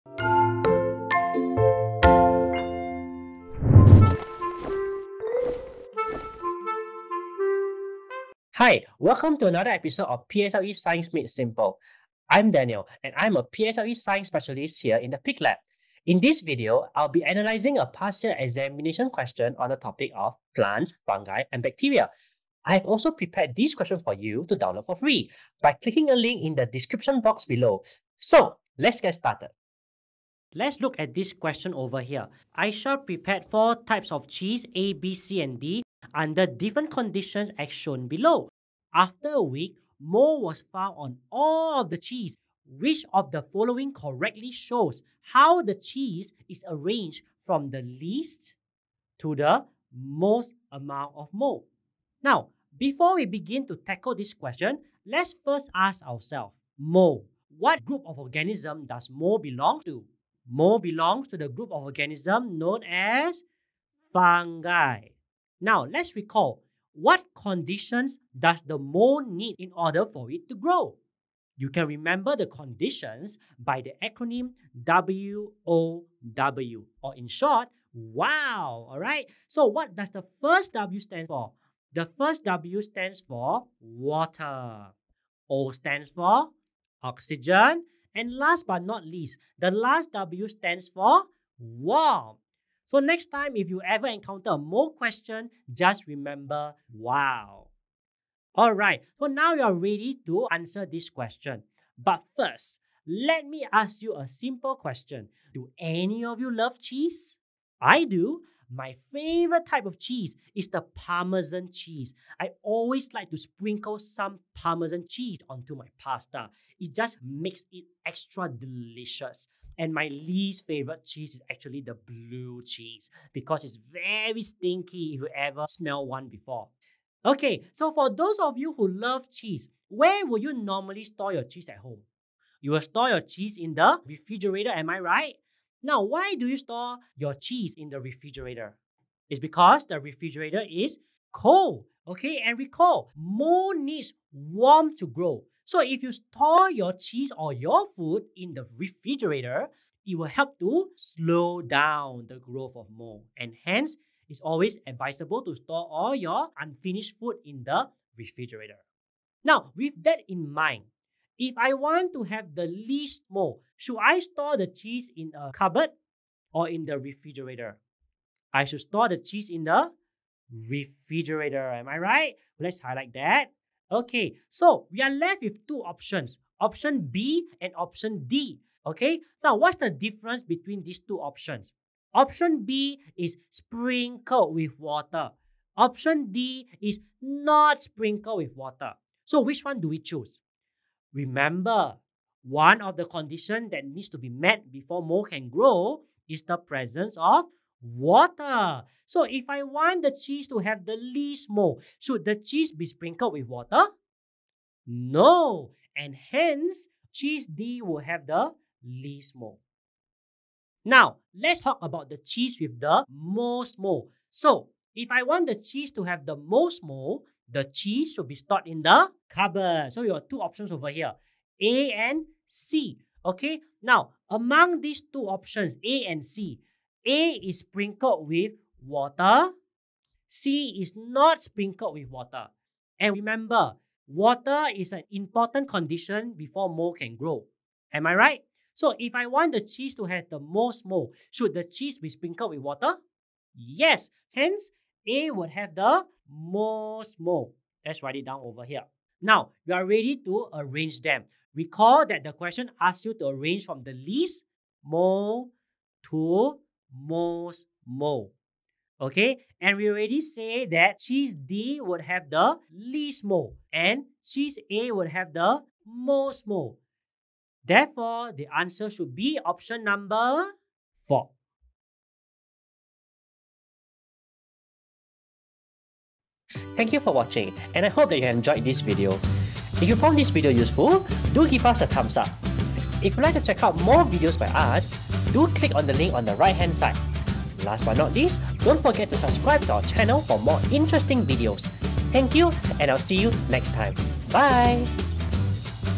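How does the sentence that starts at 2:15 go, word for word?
Now, why do you store your cheese in the refrigerator?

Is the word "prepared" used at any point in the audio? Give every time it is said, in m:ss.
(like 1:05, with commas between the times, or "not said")
0:23, 0:33.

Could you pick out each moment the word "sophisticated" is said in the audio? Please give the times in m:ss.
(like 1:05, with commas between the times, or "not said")
not said.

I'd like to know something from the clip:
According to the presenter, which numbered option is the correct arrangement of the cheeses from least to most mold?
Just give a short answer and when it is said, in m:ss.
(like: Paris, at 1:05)
4, at 4:29.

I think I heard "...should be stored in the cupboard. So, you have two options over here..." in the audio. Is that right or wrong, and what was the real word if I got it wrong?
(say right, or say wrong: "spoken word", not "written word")
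right.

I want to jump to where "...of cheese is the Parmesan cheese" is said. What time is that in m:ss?
1:49.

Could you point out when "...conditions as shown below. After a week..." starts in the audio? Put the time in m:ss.
0:36.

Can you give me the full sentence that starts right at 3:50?
C is not sprinkled with water.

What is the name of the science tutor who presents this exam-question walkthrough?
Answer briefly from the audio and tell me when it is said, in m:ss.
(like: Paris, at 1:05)
Dannial, at 0:12.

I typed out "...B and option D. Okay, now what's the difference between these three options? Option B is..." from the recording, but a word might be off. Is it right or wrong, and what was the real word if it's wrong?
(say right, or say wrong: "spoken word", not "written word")
wrong: "two", not "three".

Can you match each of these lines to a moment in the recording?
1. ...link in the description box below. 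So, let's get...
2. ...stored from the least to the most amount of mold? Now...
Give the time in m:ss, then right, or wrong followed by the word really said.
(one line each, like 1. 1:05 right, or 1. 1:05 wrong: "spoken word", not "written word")
1. 0:26 right
2. 0:46 wrong: "arranged", not "stored".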